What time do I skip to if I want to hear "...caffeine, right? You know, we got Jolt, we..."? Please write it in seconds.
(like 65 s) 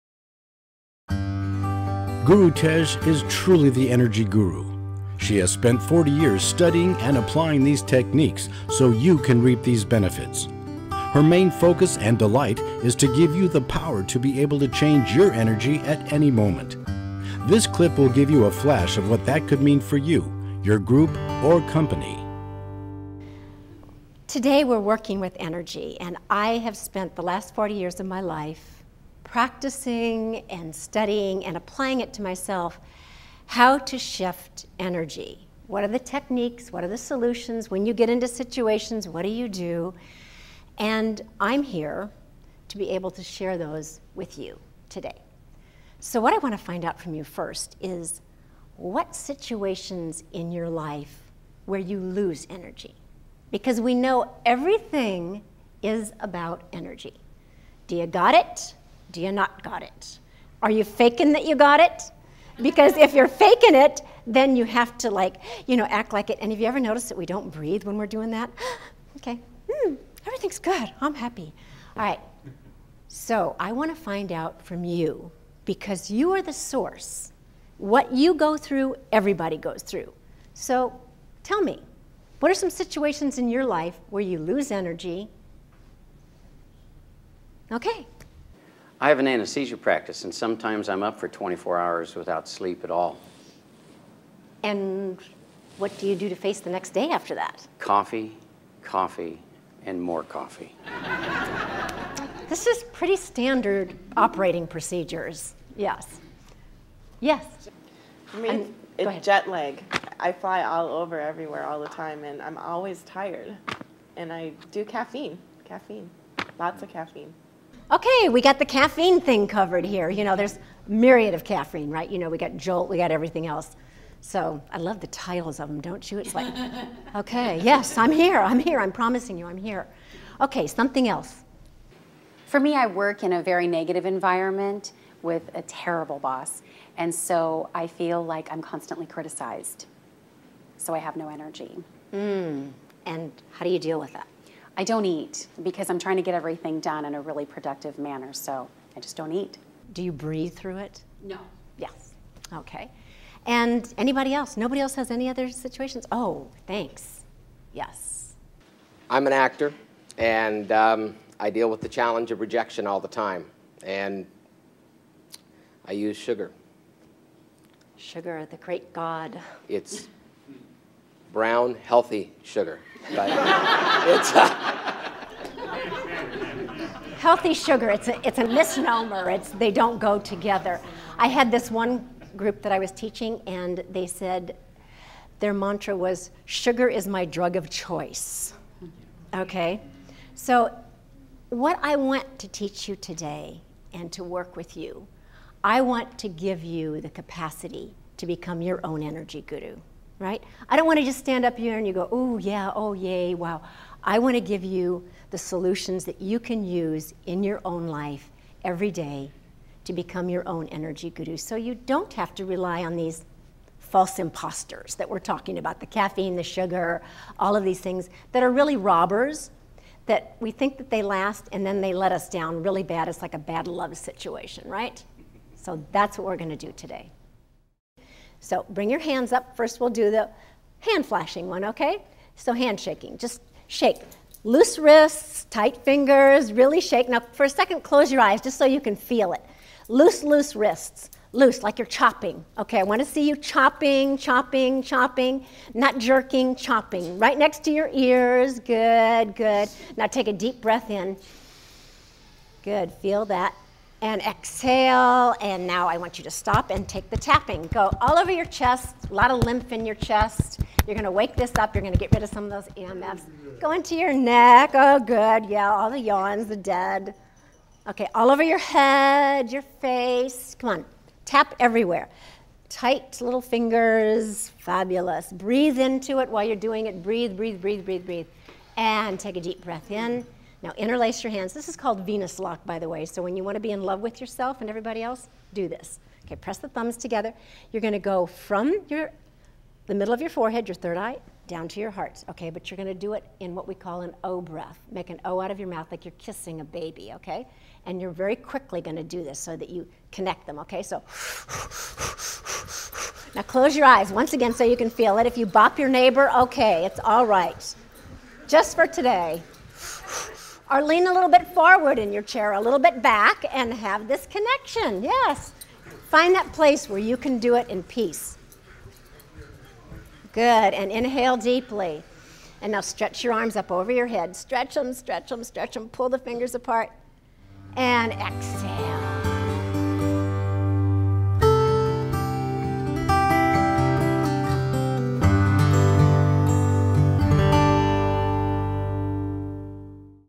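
121 s.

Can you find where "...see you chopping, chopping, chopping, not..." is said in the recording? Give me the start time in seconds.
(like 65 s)
243 s.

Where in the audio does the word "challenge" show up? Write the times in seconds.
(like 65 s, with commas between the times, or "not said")
161 s.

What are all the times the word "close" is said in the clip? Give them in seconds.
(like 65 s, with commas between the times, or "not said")
237 s, 303 s.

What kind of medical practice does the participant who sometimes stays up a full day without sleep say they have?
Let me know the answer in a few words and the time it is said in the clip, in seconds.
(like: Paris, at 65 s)
Anesthesia, at 89 s.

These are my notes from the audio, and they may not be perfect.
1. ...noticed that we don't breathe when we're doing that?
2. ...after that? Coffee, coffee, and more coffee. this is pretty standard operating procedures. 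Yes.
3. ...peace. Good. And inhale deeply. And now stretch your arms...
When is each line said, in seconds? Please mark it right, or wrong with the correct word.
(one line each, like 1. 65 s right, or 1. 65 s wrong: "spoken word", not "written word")
1. 66 s right
2. 97 s right
3. 317 s right.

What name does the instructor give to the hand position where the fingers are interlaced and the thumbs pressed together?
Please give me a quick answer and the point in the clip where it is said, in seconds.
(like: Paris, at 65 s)
Venus lock, at 282 s.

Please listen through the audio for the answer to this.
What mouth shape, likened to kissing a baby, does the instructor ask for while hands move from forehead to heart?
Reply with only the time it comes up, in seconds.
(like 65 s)
294 s.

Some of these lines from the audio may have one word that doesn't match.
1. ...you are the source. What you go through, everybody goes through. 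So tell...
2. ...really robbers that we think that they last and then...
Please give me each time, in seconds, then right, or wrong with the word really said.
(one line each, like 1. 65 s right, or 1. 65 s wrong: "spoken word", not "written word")
1. 76 s right
2. 218 s right.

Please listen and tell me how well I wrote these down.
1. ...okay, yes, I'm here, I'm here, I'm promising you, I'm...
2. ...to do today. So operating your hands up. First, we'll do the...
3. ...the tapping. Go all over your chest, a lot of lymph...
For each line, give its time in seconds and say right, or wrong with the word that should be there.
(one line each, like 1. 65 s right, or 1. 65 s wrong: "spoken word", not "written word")
1. 127 s right
2. 226 s wrong: "bring", not "operating"
3. 257 s right.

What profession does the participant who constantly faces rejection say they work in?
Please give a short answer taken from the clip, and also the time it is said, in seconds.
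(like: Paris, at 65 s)
Actor, at 159 s.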